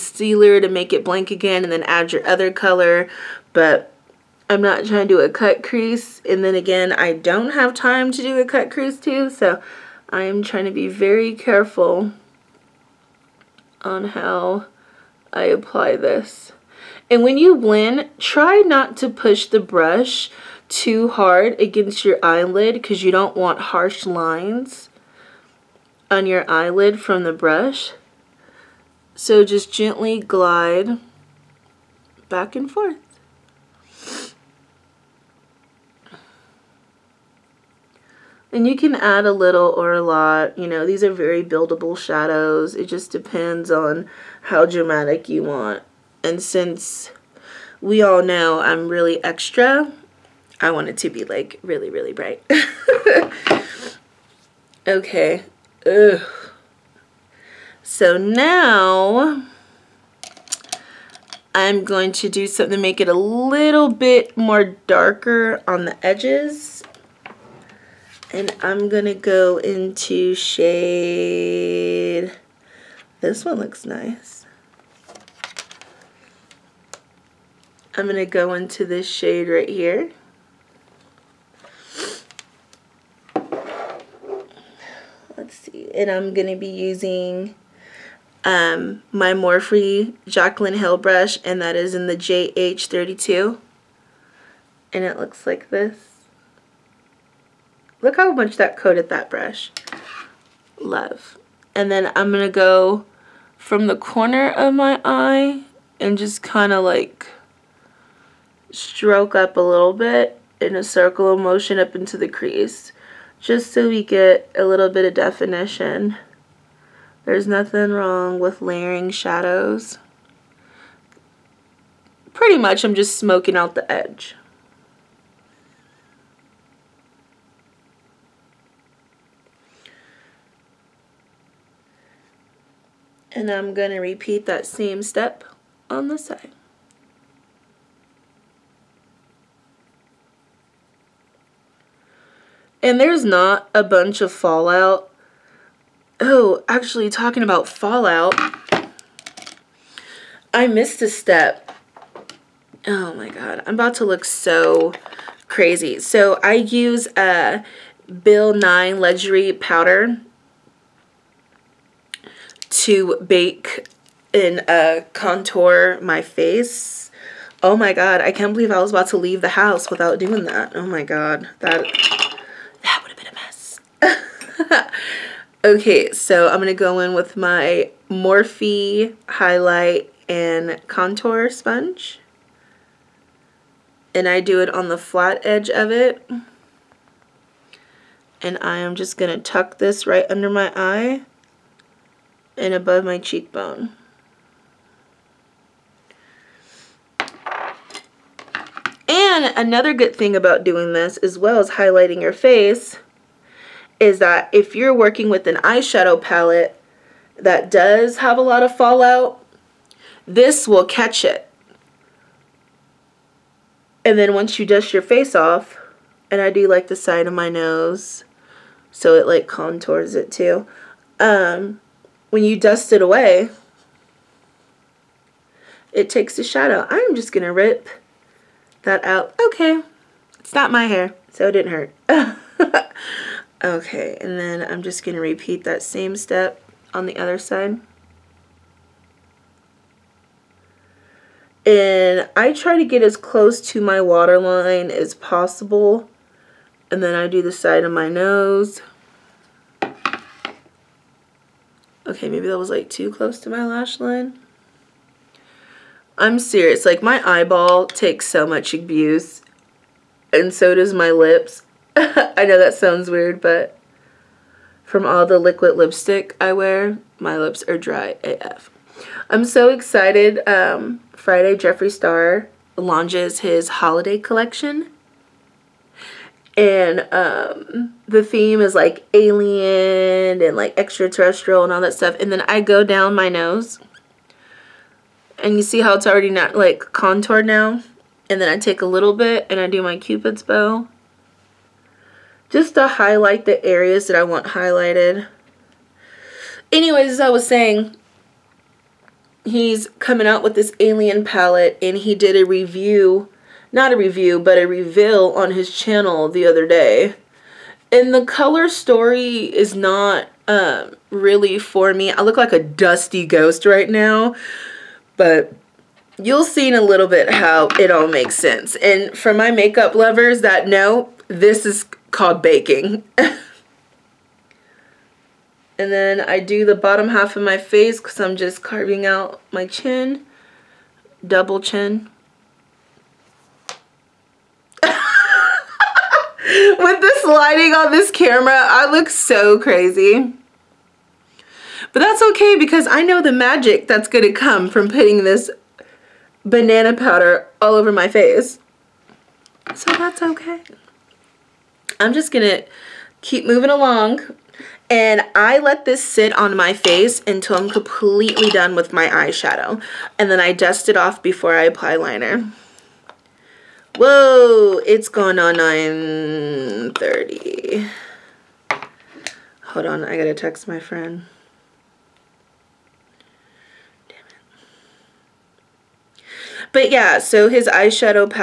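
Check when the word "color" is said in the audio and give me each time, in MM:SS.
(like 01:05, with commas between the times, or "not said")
00:02, 05:08.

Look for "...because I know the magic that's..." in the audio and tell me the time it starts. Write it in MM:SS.
05:42.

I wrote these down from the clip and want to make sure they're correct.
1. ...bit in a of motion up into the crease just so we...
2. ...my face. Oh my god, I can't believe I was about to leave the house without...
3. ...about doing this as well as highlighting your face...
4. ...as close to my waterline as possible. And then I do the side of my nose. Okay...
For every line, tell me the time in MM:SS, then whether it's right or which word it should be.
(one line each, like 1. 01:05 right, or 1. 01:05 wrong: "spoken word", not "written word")
1. 01:49 right
2. 02:46 right
3. 03:20 right
4. 04:03 right.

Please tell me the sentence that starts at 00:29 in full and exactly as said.
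So just gently glide back and forth.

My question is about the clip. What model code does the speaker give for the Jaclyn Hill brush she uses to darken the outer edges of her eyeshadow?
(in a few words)
JH32.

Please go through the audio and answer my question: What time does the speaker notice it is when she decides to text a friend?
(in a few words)
9:30.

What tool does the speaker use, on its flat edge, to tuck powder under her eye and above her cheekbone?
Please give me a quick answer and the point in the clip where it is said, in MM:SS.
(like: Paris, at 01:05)
Morphe highlight and contour sponge, at 02:58.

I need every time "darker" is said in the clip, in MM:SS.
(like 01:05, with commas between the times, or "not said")
01:04.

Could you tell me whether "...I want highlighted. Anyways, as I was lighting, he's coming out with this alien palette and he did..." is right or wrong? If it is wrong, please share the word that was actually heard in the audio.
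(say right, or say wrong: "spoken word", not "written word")
wrong: "saying", not "lighting".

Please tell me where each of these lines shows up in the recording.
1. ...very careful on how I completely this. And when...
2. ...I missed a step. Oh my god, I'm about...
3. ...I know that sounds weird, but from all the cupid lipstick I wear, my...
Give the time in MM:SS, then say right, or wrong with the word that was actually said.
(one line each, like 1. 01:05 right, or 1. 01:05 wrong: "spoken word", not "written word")
1. 00:10 wrong: "apply", not "completely"
2. 02:30 right
3. 04:21 wrong: "liquid", not "cupid".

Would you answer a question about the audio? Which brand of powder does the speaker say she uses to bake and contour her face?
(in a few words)
Ben Nye.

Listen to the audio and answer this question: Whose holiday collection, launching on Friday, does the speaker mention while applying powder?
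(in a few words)
Jeffree Star.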